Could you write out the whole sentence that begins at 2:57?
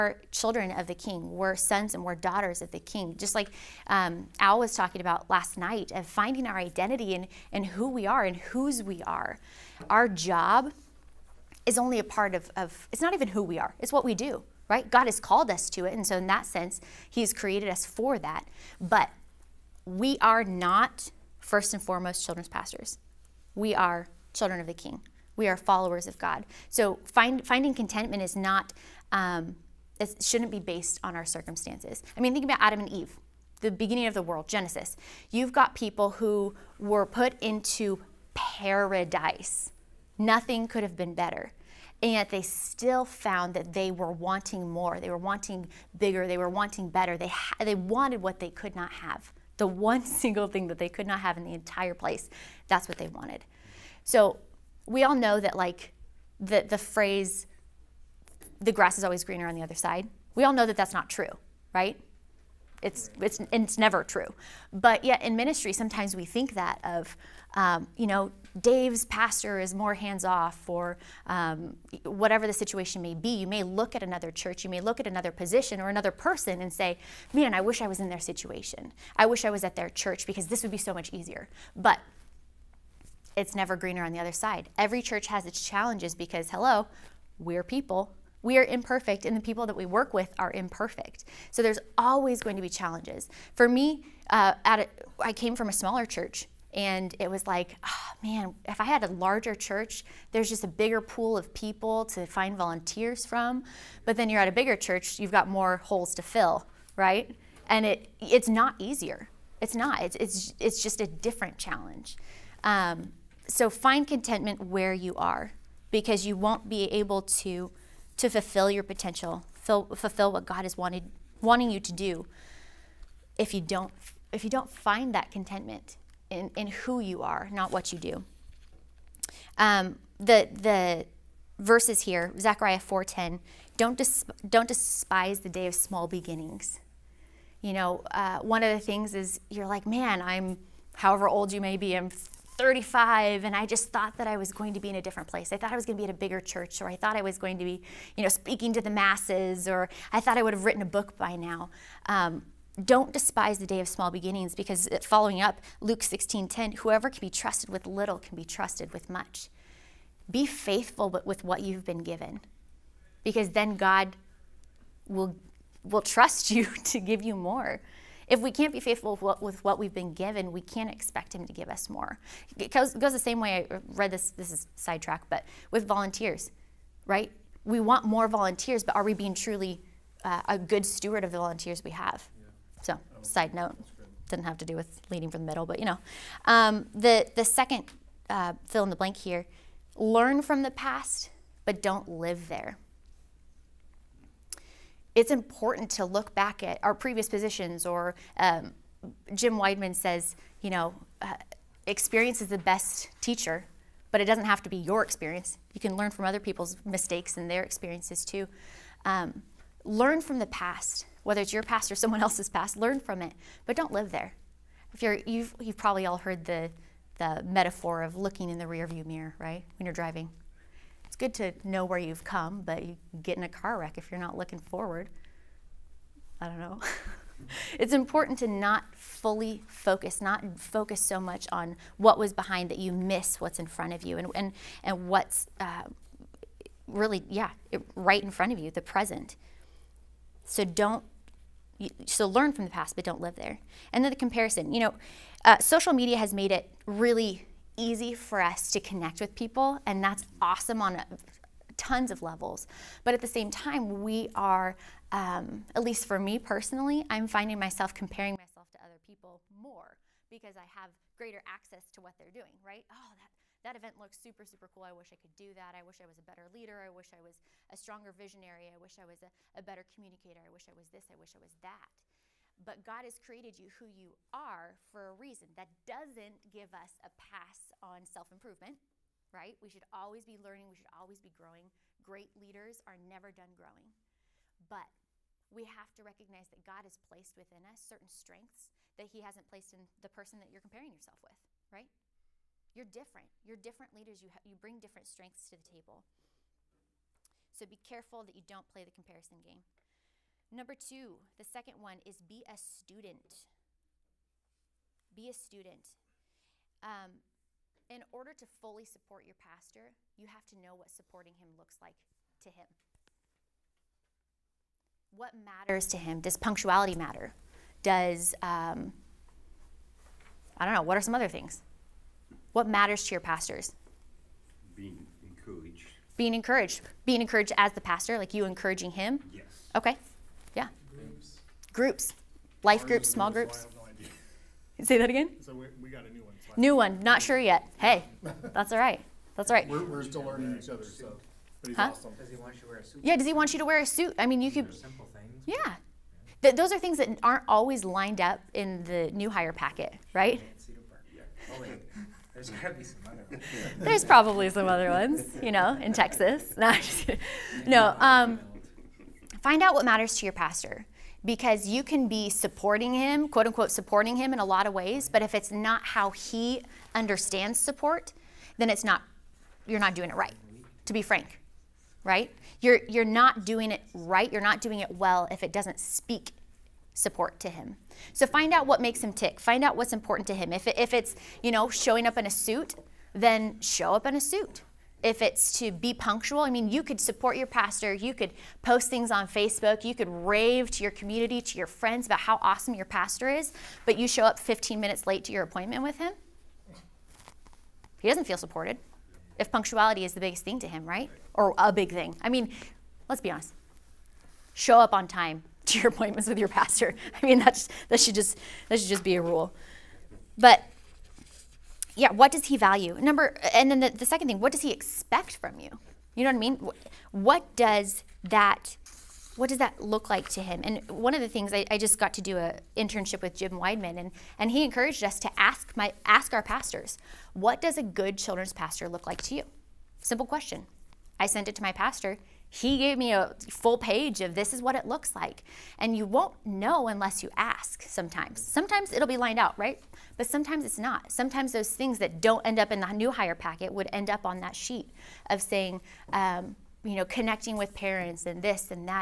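We want more volunteers but are we being truly uh, a good steward of the volunteers we have?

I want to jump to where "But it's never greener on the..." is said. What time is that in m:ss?
1:21.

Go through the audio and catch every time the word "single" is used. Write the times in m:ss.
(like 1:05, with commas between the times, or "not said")
0:50.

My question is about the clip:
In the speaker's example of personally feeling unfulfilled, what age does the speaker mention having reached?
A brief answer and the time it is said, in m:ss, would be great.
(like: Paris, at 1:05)
35, at 2:22.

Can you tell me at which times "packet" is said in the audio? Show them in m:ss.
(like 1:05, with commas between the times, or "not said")
5:49, 7:23.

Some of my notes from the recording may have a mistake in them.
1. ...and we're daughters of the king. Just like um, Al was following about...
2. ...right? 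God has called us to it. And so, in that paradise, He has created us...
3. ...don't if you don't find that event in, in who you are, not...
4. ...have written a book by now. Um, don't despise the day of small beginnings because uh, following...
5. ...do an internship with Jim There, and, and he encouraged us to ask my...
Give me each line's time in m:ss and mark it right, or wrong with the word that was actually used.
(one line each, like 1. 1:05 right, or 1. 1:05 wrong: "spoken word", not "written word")
1. 0:01 wrong: "talking", not "following"
2. 0:14 wrong: "sense", not "paradise"
3. 2:03 wrong: "contentment", not "event"
4. 2:30 right
5. 7:02 wrong: "Wideman", not "There".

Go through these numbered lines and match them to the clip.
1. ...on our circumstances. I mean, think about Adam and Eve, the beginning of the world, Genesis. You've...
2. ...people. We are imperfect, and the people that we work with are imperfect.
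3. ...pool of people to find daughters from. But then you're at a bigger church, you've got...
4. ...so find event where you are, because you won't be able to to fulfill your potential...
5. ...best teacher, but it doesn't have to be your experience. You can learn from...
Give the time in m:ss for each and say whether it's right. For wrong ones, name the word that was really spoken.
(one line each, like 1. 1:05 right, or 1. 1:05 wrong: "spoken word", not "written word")
1. 0:31 right
2. 1:27 right
3. 1:41 wrong: "volunteers", not "daughters"
4. 1:53 wrong: "contentment", not "event"
5. 3:22 right.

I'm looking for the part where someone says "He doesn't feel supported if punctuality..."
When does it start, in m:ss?
6:38.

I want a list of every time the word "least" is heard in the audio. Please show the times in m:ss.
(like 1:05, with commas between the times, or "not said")
4:15.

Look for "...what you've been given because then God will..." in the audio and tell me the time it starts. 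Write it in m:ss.
2:41.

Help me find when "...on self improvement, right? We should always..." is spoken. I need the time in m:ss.
4:37.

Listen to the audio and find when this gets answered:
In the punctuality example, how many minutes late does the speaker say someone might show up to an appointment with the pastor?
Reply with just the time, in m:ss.
6:34.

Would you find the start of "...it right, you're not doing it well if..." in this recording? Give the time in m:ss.
6:13.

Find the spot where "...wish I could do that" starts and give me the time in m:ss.
4:24.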